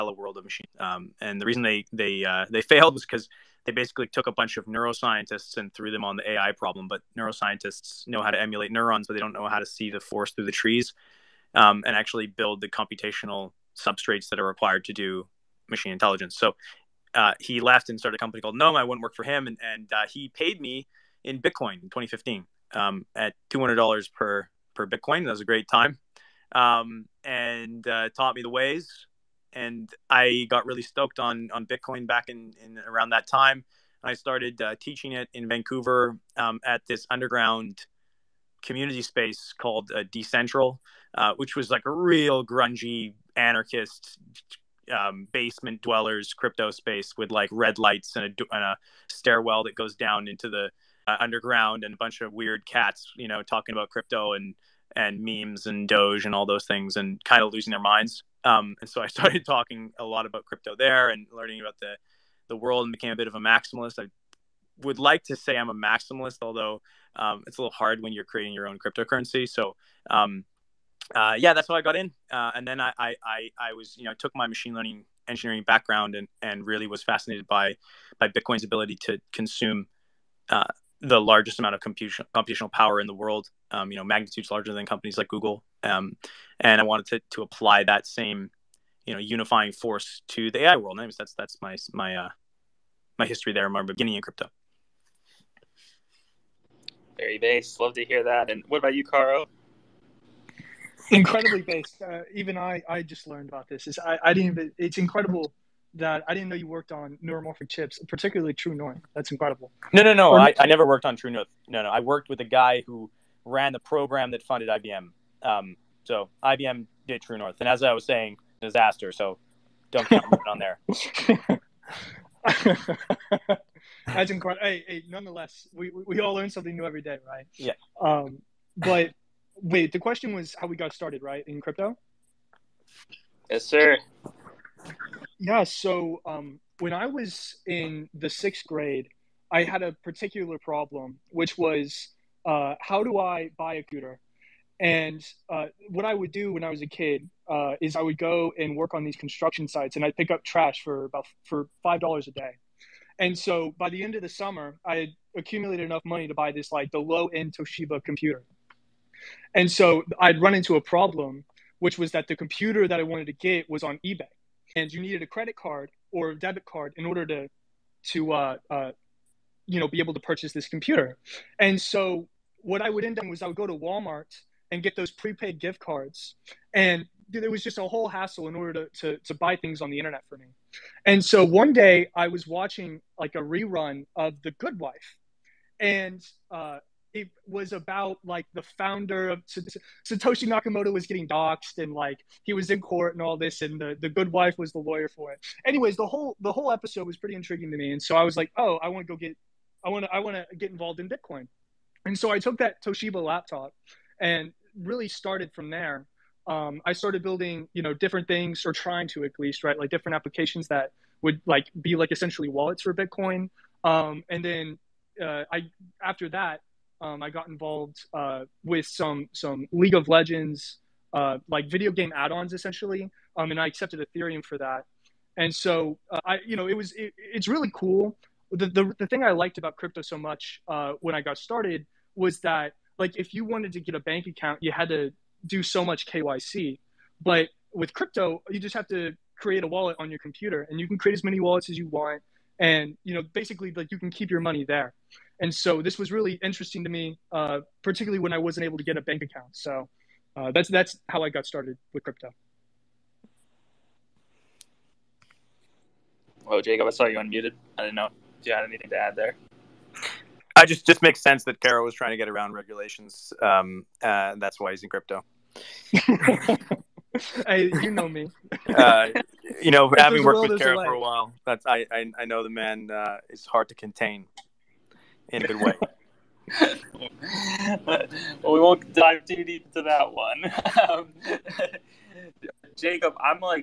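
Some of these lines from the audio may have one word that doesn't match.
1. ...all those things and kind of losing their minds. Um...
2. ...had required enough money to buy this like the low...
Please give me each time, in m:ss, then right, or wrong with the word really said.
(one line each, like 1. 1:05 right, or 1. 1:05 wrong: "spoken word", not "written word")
1. 0:56 right
2. 2:34 wrong: "accumulated", not "required".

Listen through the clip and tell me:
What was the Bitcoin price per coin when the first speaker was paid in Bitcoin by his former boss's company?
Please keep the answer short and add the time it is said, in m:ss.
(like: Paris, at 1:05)
$200, at 0:23.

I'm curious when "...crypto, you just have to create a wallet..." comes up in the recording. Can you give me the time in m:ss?
3:57.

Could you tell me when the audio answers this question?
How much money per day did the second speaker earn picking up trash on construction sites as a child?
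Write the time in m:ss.
2:31.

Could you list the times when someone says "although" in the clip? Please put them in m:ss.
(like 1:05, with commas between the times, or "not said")
1:06.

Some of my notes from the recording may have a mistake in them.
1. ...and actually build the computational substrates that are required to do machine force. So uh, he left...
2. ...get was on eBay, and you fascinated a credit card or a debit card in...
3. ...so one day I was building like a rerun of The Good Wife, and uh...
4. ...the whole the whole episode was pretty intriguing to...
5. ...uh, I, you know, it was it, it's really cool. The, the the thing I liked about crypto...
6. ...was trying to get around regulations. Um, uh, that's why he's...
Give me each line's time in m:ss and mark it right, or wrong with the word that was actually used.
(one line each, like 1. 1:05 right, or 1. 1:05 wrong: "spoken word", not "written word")
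1. 0:11 wrong: "intelligence", not "force"
2. 2:43 wrong: "needed", not "fascinated"
3. 3:01 wrong: "watching", not "building"
4. 3:15 right
5. 3:46 right
6. 4:21 right.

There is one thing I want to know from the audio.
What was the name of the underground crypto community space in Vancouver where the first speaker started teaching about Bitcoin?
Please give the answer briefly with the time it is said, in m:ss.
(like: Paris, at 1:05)
Decentral, at 0:40.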